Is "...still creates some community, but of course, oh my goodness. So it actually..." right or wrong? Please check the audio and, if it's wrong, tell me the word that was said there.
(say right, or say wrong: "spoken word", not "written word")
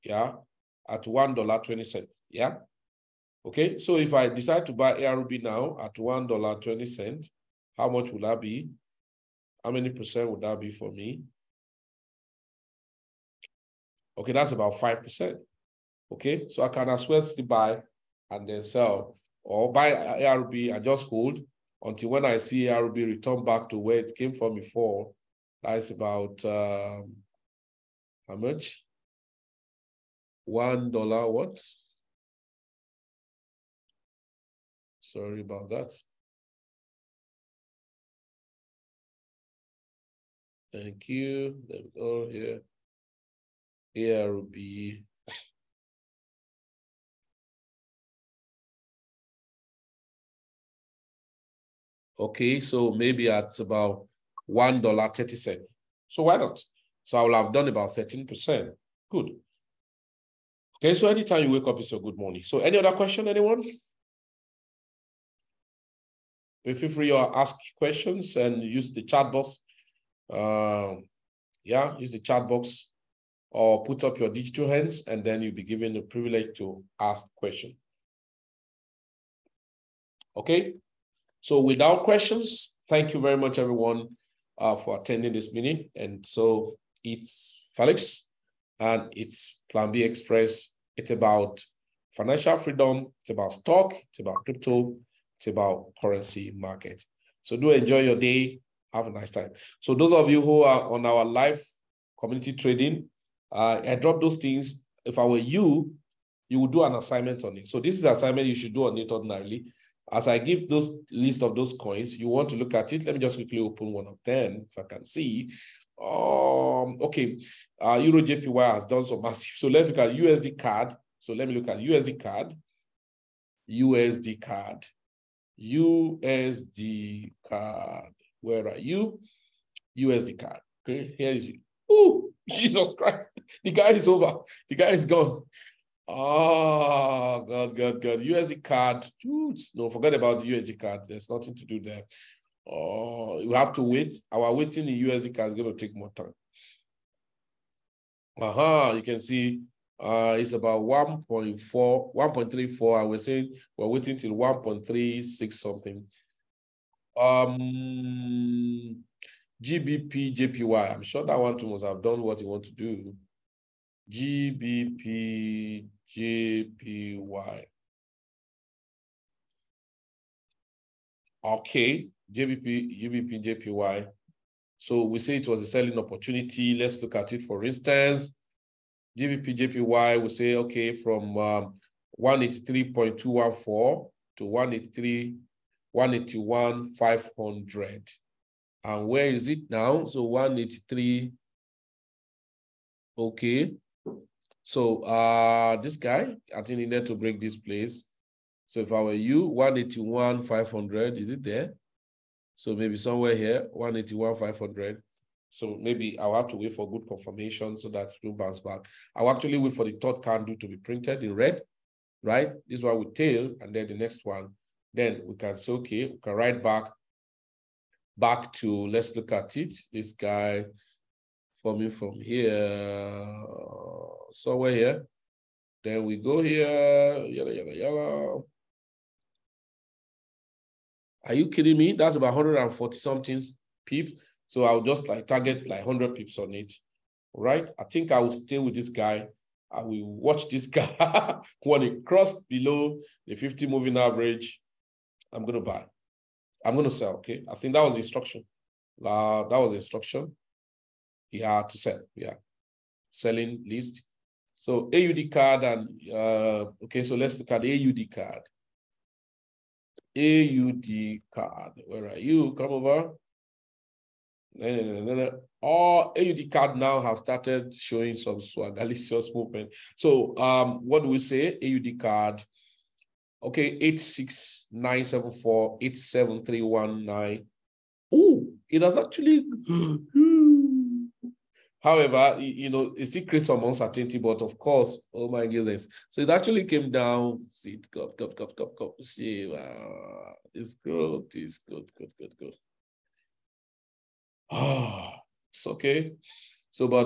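wrong: "uncertainty", not "community".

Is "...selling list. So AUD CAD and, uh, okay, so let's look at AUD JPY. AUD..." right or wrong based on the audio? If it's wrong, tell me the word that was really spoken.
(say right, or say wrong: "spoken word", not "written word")
wrong: "CAD", not "JPY".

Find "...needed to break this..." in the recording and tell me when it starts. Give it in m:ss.
3:16.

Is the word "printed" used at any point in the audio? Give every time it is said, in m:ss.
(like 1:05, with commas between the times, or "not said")
3:30.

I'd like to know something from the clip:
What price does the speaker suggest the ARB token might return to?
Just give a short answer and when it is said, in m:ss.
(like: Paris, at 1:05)
$1.30, at 0:54.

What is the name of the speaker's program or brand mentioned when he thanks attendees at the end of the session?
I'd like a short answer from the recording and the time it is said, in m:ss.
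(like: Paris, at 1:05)
Plan B Express, at 1:29.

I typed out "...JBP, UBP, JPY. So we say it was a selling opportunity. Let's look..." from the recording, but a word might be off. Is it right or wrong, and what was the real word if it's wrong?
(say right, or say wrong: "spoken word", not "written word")
right.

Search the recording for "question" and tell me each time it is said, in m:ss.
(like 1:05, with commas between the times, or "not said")
1:02, 1:07, 1:17, 1:22.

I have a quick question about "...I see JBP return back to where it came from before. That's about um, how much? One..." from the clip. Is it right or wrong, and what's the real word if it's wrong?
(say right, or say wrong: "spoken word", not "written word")
wrong: "ARB", not "JBP".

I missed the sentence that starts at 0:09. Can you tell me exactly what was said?
How many percent would that be for me?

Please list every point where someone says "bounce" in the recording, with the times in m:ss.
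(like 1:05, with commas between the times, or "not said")
3:28.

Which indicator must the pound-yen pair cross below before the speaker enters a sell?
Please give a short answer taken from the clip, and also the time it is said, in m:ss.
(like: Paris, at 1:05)
50 moving average, at 4:03.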